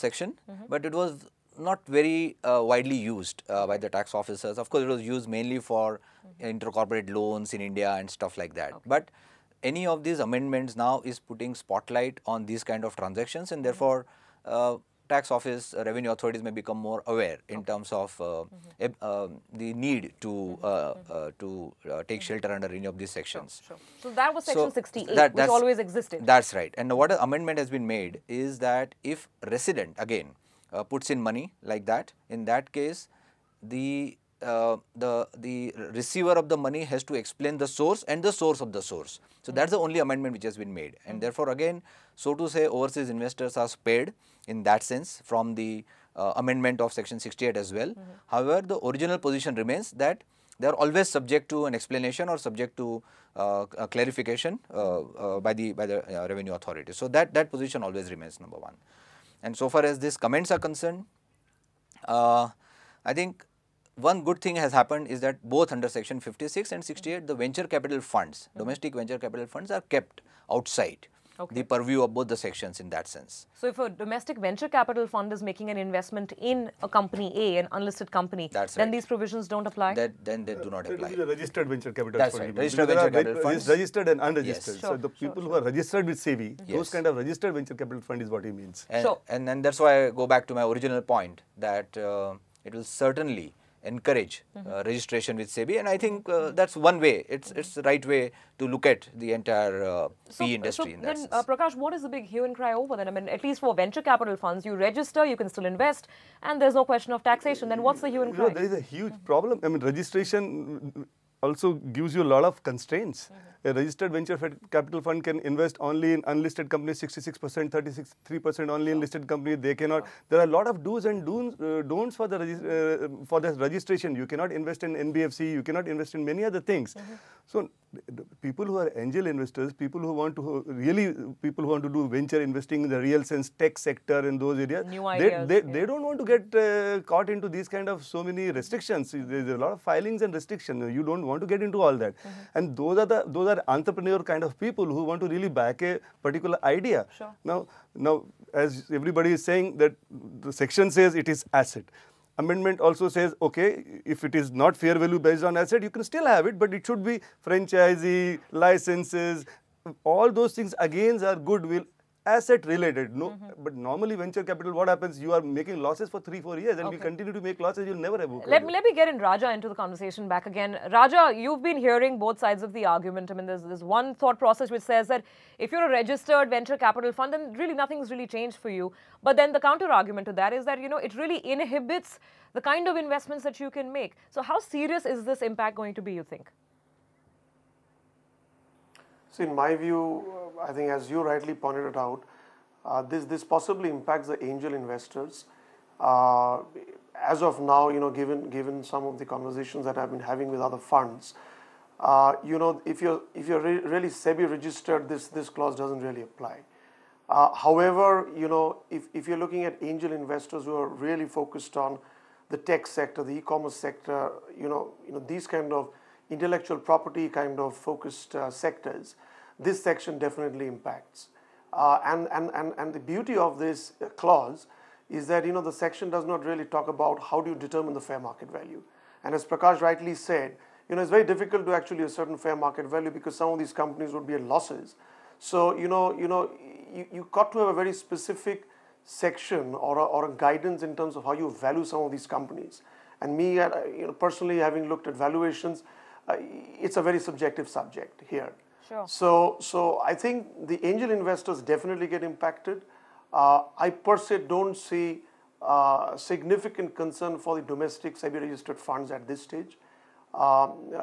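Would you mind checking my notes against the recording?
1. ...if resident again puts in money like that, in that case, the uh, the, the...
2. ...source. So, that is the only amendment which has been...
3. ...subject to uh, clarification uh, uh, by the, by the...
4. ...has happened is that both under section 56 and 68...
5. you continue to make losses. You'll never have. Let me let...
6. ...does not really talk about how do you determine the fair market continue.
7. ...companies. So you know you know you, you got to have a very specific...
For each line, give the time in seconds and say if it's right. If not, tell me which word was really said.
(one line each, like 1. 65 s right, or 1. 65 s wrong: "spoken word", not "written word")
1. 29 s right
2. 38 s right
3. 52 s right
4. 64 s right
5. 166 s right
6. 226 s wrong: "value", not "continue"
7. 234 s wrong: "losses", not "companies".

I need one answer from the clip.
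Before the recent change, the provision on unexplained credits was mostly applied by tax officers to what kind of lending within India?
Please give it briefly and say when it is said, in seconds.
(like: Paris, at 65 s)
intercorporate loans, at 6 s.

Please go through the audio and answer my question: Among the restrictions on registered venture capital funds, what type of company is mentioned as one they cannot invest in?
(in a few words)
NBFC.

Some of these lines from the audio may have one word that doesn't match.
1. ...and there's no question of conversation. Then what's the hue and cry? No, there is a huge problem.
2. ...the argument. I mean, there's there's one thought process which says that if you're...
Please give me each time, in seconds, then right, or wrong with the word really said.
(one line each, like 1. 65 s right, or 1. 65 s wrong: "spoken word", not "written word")
1. 106 s wrong: "taxation", not "conversation"
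2. 172 s right.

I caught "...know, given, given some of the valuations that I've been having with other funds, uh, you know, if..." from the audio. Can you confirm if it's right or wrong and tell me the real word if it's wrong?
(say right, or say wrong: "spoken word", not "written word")
wrong: "conversations", not "valuations".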